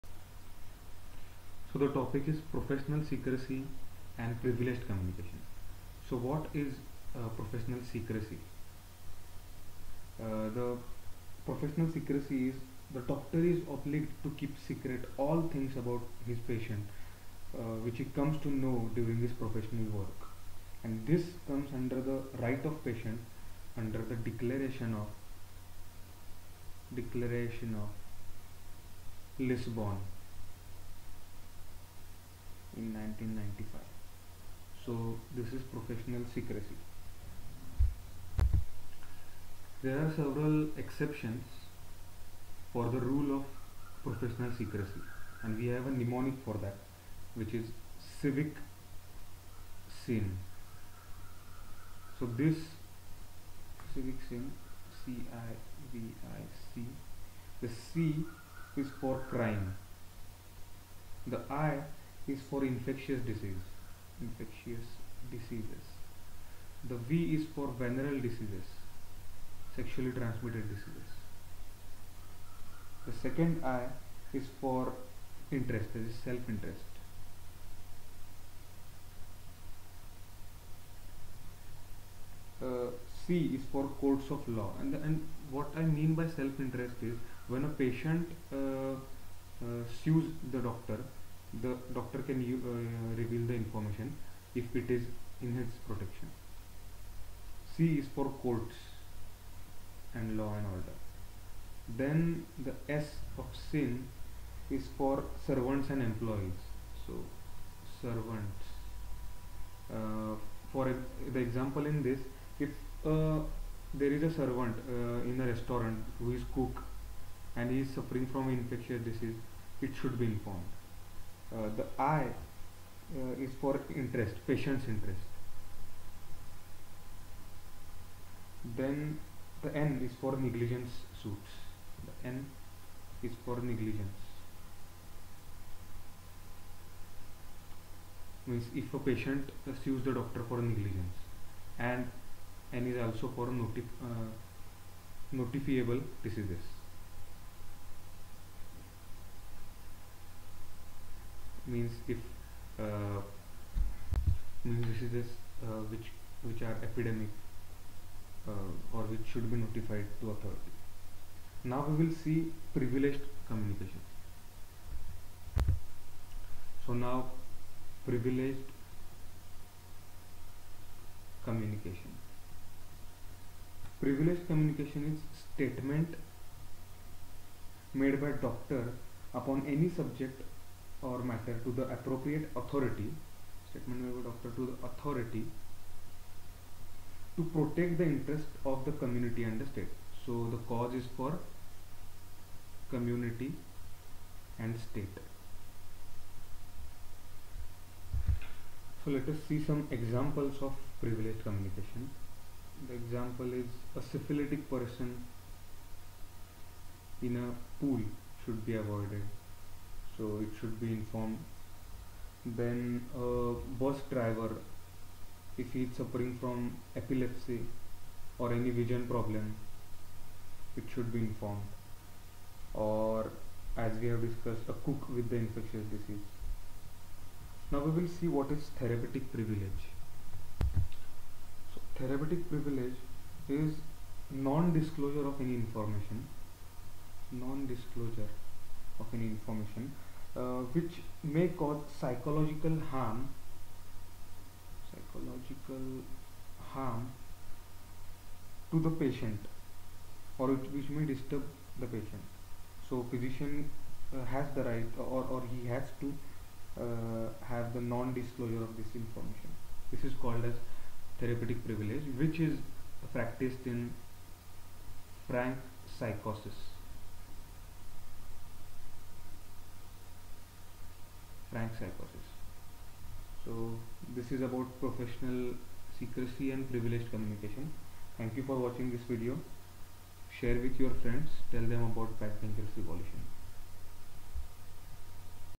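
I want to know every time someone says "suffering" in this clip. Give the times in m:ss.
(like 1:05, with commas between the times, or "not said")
1:57, 3:35.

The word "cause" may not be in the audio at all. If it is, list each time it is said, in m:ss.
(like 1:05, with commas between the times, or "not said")
3:10, 4:01.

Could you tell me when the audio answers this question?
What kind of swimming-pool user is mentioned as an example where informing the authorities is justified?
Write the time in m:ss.
3:24.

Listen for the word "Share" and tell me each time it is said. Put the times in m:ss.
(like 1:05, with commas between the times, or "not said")
4:40.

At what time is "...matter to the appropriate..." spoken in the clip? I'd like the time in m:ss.
3:01.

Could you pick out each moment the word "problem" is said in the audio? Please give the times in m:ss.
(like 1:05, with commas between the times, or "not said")
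3:39.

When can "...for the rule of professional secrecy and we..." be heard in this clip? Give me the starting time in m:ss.
0:42.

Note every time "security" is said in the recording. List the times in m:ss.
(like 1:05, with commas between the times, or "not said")
not said.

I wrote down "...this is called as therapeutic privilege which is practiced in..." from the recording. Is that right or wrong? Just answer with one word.
right.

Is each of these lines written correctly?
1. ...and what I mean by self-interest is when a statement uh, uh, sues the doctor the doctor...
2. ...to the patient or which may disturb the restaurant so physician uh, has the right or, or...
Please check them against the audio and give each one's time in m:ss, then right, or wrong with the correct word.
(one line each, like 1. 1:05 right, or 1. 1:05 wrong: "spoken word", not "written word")
1. 1:25 wrong: "patient", not "statement"
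2. 4:08 wrong: "patient", not "restaurant".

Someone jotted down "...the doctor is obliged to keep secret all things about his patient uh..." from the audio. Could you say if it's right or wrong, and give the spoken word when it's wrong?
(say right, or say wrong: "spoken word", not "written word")
right.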